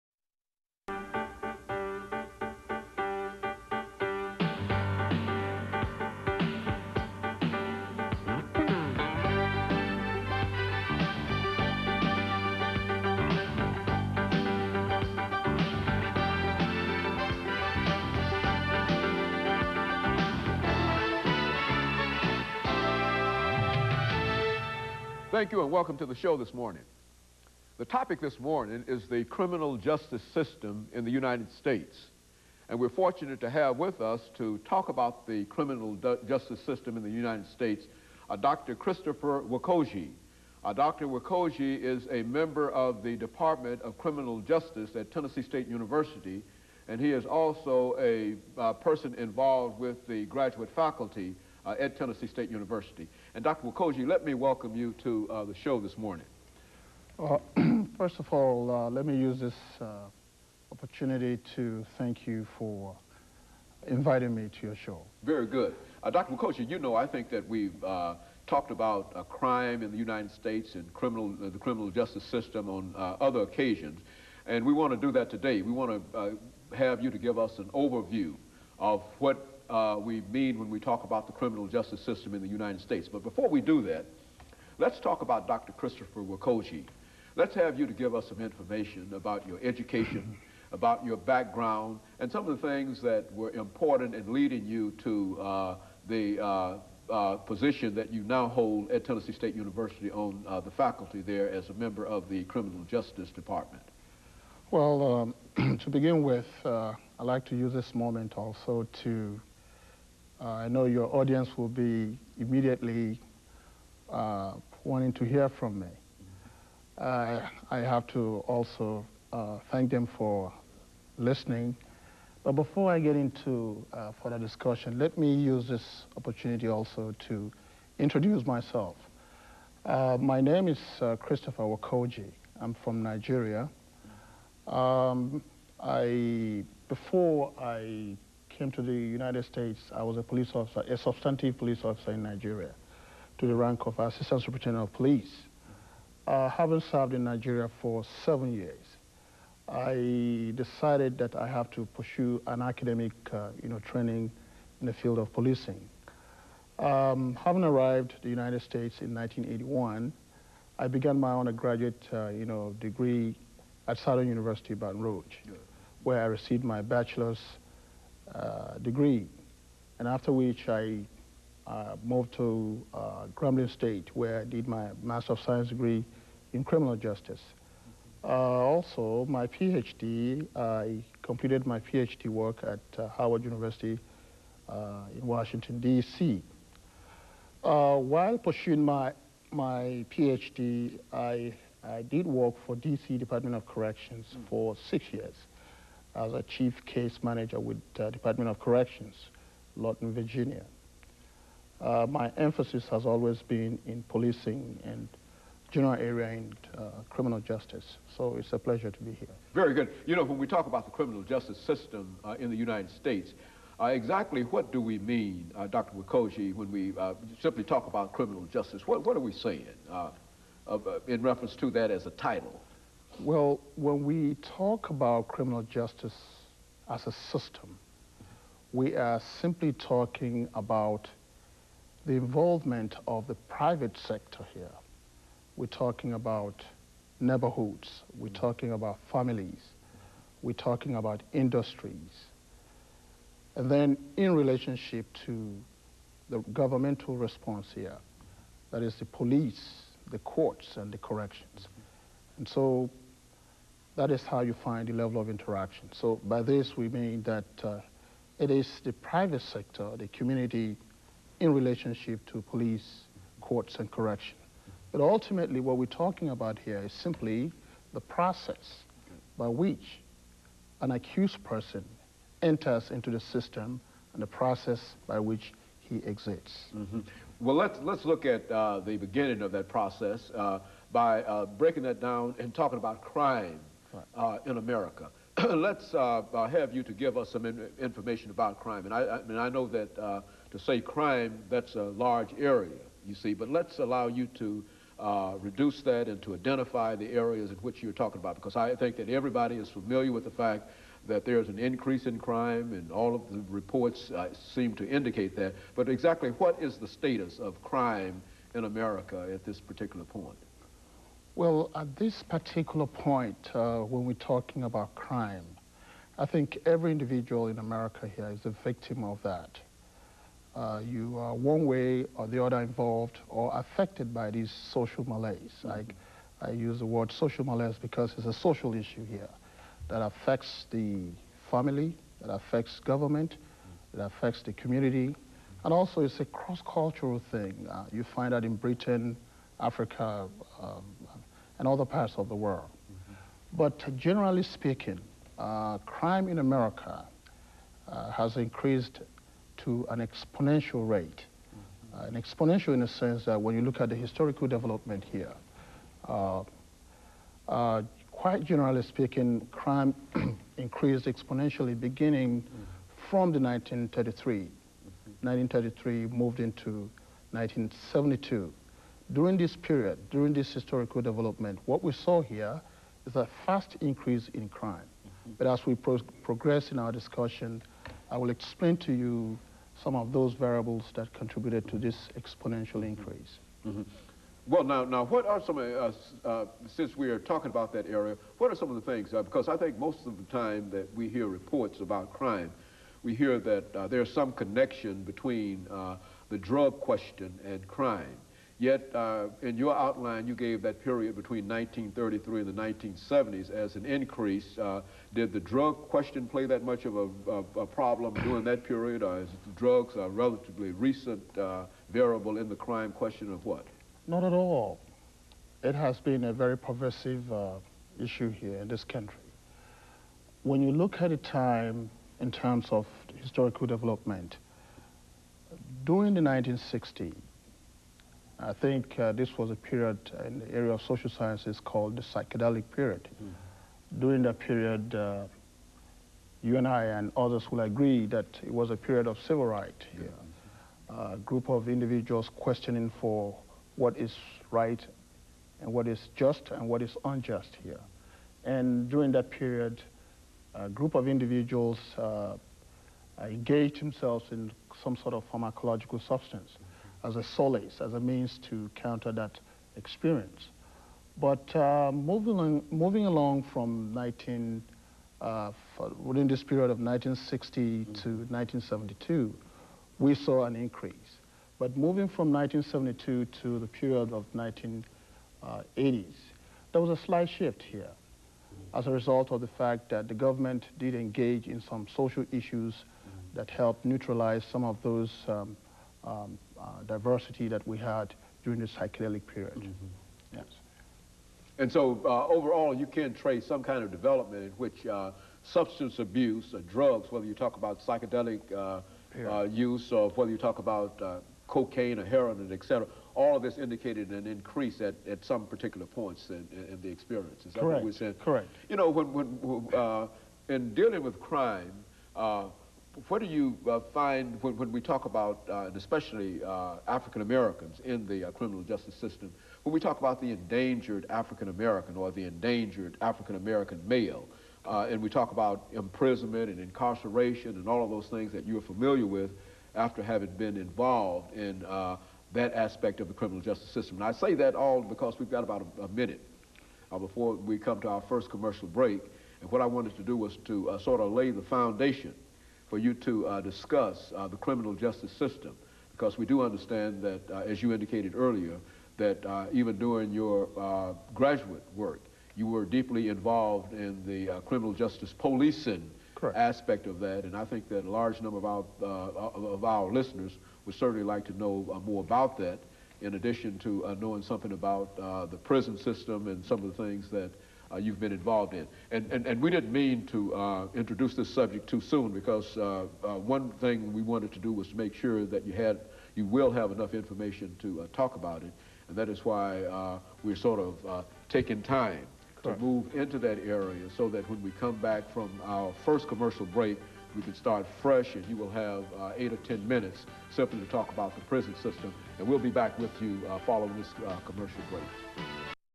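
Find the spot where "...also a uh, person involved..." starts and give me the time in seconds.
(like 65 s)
47 s.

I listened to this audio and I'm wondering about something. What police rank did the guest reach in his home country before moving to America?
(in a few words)
Assistant Superintendent of Police.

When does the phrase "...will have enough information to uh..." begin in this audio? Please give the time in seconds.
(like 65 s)
576 s.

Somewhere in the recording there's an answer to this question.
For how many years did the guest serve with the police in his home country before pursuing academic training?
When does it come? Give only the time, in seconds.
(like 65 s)
148 s.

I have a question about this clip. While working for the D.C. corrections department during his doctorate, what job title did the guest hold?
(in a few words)
chief case manager.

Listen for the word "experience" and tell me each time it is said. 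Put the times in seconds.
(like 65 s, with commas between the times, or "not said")
459 s, 506 s.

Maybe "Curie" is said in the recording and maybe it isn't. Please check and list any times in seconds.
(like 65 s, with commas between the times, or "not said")
not said.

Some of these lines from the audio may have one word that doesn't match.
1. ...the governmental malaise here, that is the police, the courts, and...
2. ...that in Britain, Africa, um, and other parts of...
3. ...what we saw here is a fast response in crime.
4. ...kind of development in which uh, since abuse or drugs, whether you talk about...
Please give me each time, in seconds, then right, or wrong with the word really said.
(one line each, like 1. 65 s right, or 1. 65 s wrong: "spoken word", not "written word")
1. 246 s wrong: "response", not "malaise"
2. 338 s right
3. 371 s wrong: "increase", not "response"
4. 493 s wrong: "substance", not "since".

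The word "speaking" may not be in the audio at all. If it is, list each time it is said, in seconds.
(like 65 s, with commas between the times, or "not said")
344 s, 358 s.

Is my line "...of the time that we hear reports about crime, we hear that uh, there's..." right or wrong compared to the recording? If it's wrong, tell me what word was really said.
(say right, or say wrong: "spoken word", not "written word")
right.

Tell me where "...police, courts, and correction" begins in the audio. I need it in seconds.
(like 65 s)
262 s.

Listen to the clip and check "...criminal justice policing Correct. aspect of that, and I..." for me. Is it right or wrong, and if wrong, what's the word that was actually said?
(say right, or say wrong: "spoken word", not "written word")
right.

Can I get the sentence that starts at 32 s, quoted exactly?
And we're fortunate to have with us to talk about the criminal justice system in the United States, uh, Dr.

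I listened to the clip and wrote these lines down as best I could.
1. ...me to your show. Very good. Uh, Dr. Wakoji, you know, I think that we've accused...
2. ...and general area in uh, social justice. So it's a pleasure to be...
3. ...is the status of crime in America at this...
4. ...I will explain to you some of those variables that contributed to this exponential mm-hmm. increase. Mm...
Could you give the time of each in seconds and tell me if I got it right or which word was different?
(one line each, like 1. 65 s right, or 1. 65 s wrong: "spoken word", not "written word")
1. 64 s wrong: "talked", not "accused"
2. 204 s wrong: "criminal", not "social"
3. 306 s right
4. 378 s right.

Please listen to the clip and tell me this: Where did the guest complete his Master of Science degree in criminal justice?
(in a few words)
Grambling State.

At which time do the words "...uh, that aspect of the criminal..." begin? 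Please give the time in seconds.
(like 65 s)
531 s.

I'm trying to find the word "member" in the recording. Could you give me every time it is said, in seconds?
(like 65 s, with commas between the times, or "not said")
42 s, 101 s.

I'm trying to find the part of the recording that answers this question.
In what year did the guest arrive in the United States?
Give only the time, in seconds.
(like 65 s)
159 s.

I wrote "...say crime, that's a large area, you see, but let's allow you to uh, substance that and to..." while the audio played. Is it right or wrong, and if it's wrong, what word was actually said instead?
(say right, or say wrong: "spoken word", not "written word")
wrong: "reduce", not "substance".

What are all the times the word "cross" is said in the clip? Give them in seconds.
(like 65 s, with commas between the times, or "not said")
336 s.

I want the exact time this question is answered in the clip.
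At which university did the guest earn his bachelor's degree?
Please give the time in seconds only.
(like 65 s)
163 s.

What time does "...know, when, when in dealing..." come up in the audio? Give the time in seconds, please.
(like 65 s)
508 s.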